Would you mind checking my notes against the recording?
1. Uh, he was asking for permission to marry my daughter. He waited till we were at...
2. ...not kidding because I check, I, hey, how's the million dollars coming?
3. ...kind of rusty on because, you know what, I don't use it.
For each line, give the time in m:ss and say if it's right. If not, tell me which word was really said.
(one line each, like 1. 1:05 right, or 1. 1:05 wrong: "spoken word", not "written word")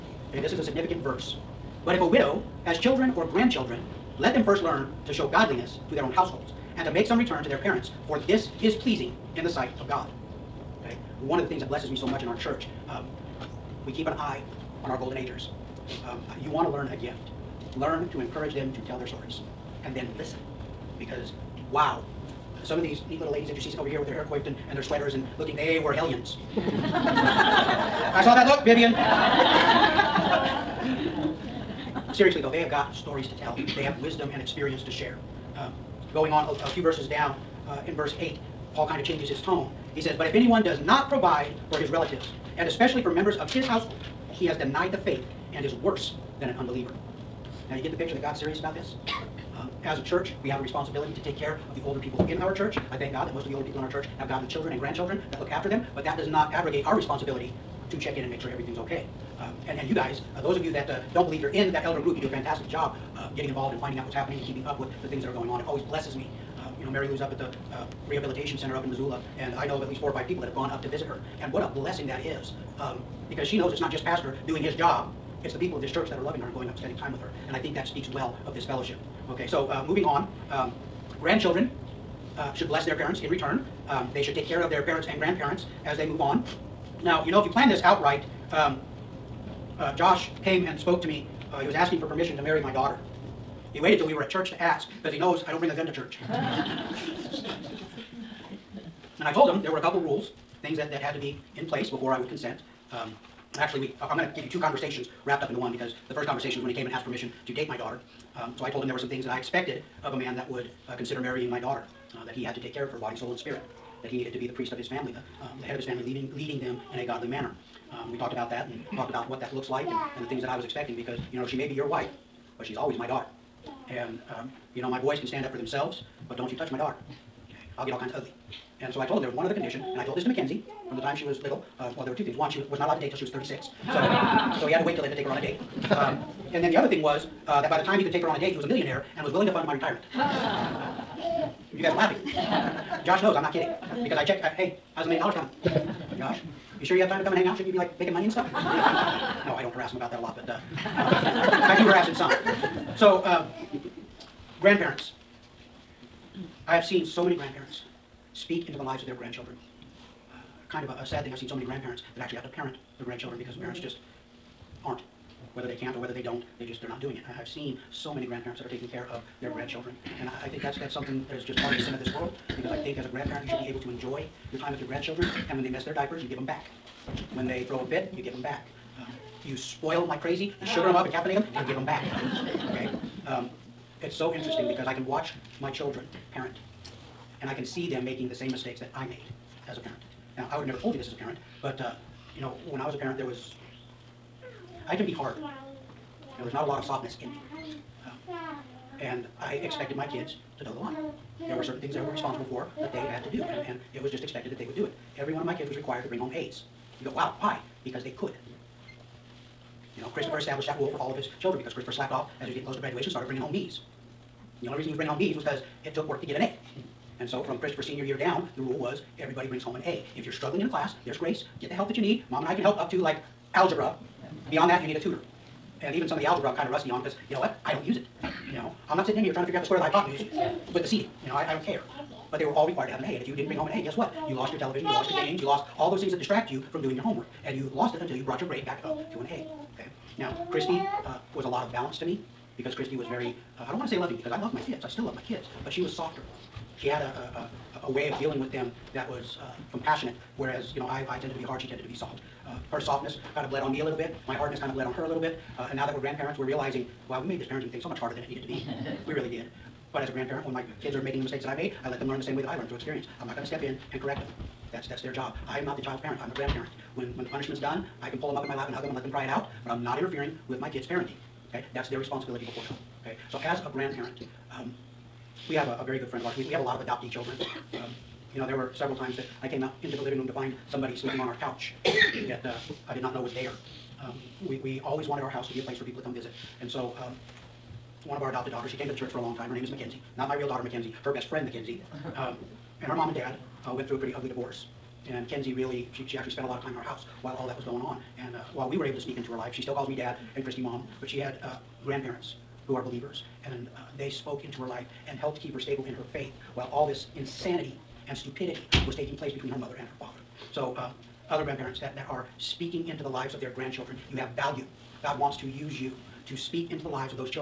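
1. 1:31 right
2. 2:23 right
3. 3:46 right.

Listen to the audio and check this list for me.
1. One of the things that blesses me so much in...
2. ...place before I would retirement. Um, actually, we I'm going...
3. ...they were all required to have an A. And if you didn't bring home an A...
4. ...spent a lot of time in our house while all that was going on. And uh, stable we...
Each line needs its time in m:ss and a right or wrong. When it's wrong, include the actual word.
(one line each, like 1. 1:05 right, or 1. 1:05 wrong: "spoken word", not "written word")
1. 0:11 right
2. 1:41 wrong: "consent", not "retirement"
3. 3:52 right
4. 4:56 wrong: "while", not "stable".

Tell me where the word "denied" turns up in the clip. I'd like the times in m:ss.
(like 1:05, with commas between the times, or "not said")
0:44.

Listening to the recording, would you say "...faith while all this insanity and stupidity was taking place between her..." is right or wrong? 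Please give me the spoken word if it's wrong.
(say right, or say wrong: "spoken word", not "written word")
right.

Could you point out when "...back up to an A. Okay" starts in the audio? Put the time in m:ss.
3:58.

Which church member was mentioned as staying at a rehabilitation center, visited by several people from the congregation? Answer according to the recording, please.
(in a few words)
Mary Lou.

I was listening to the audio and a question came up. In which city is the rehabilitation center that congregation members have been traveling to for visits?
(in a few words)
Missoula.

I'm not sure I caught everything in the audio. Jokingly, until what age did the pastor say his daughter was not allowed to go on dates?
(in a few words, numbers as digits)
36.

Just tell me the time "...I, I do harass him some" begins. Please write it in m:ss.
2:30.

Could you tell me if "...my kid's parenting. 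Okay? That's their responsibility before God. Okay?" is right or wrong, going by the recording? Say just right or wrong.
right.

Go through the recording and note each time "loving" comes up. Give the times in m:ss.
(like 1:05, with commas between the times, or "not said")
1:16, 4:03.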